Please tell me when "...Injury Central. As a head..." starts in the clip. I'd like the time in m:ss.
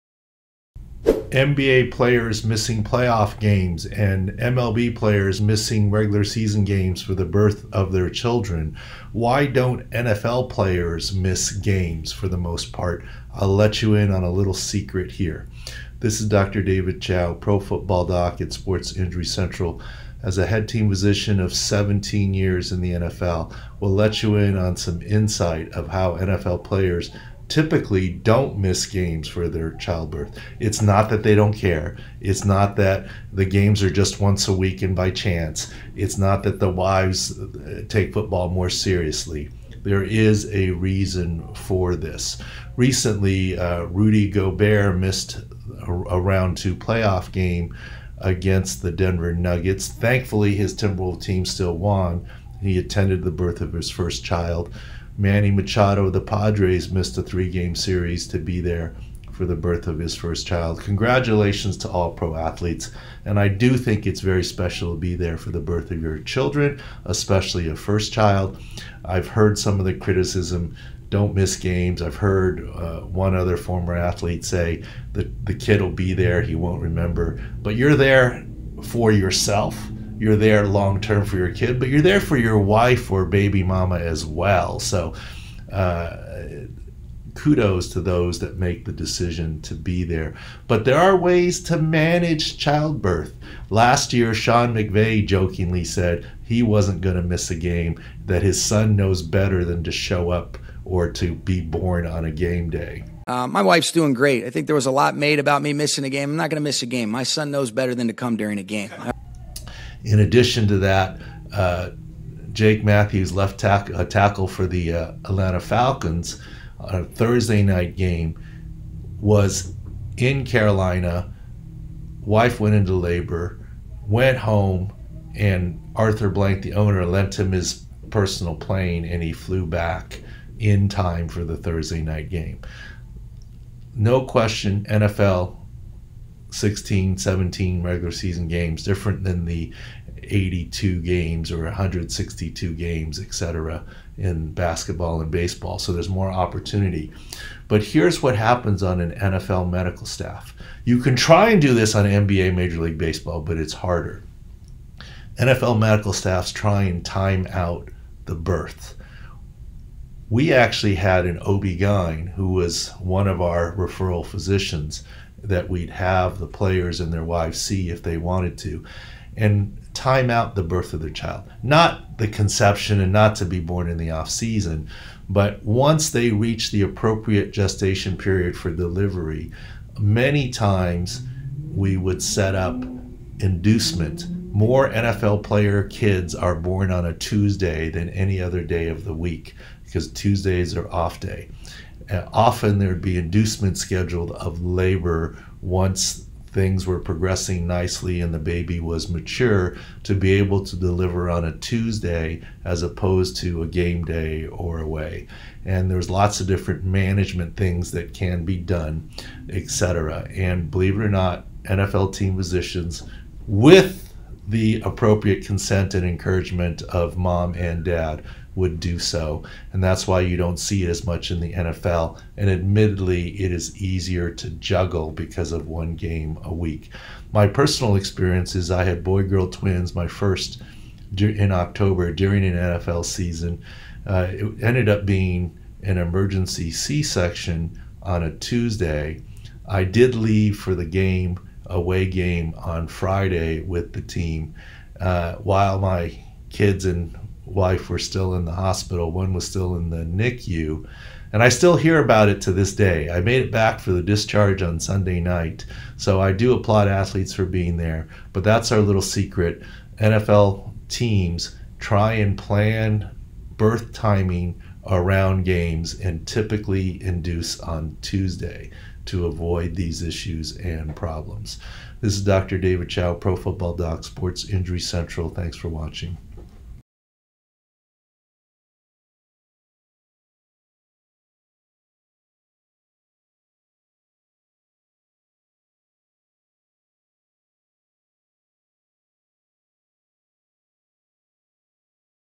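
0:18.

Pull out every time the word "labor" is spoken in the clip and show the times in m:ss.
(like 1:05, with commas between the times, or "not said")
2:02, 3:14.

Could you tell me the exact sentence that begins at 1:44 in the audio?
I think there was a lot made about me missing a game.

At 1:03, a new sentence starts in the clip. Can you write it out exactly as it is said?
And I do think it's very special to be there for the birth of your children, especially a first child.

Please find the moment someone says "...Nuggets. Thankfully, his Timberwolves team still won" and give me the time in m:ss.
0:49.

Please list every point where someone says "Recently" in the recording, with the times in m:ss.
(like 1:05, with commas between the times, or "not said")
0:42.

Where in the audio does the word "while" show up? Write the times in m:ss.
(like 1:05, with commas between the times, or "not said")
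4:05.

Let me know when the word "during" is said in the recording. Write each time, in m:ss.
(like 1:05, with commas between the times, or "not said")
1:48, 3:52.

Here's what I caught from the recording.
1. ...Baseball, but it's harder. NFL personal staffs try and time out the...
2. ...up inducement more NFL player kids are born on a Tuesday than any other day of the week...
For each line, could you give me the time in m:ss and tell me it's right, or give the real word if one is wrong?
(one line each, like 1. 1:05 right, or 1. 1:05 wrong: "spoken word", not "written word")
1. 2:32 wrong: "medical", not "personal"
2. 3:02 right.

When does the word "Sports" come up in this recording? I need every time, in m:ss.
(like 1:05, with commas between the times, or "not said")
0:18, 4:34.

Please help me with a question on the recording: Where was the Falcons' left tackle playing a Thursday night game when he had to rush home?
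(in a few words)
Carolina.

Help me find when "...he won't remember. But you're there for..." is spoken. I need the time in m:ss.
1:16.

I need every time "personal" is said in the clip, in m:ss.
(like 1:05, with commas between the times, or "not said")
2:08, 3:47.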